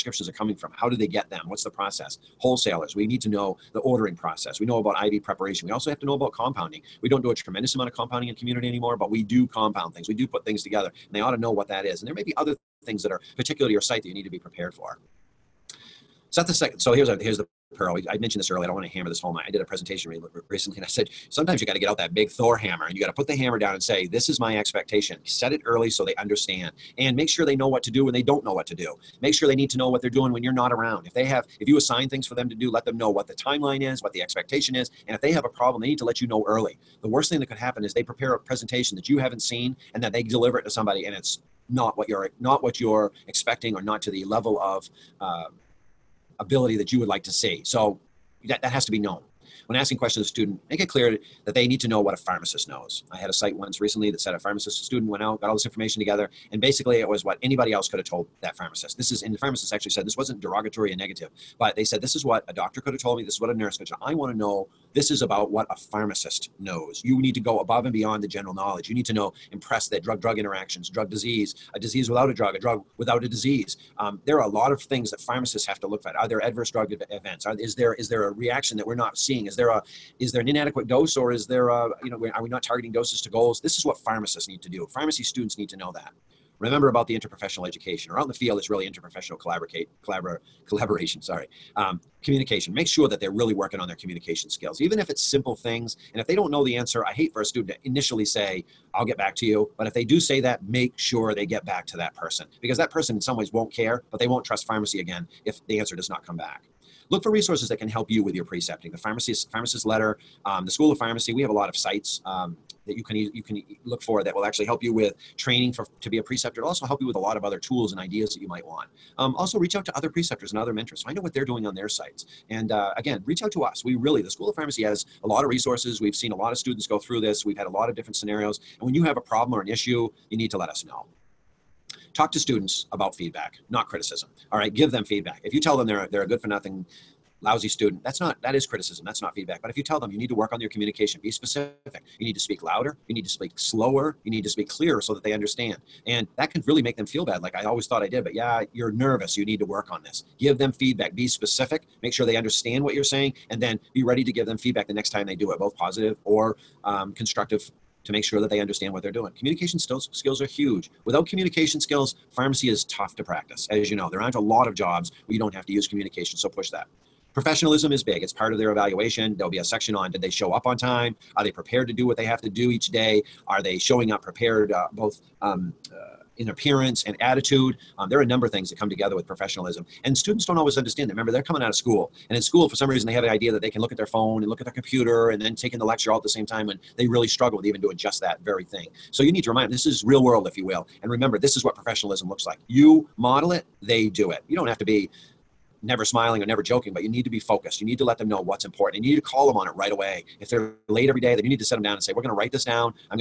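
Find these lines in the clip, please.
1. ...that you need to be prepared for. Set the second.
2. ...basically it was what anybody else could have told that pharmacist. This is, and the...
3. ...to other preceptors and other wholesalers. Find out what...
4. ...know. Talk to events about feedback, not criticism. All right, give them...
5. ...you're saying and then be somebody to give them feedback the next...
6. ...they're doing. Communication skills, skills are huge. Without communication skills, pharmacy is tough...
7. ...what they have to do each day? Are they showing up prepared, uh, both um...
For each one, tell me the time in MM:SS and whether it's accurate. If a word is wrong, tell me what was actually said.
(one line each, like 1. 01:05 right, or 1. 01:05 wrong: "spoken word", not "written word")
1. 00:14 right
2. 00:56 right
3. 01:59 wrong: "mentors", not "wholesalers"
4. 02:10 wrong: "students", not "events"
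5. 02:32 wrong: "ready", not "somebody"
6. 02:39 right
7. 02:52 right.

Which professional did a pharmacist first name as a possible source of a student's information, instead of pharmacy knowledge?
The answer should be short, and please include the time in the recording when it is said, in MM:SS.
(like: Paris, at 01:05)
a doctor, at 01:02.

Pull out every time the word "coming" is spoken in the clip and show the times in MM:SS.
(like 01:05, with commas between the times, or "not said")
00:00, 03:01.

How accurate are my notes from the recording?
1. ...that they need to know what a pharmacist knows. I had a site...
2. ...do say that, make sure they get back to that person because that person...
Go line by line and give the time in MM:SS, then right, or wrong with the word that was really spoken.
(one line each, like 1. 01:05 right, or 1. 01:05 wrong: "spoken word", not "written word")
1. 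00:51 right
2. 01:40 right.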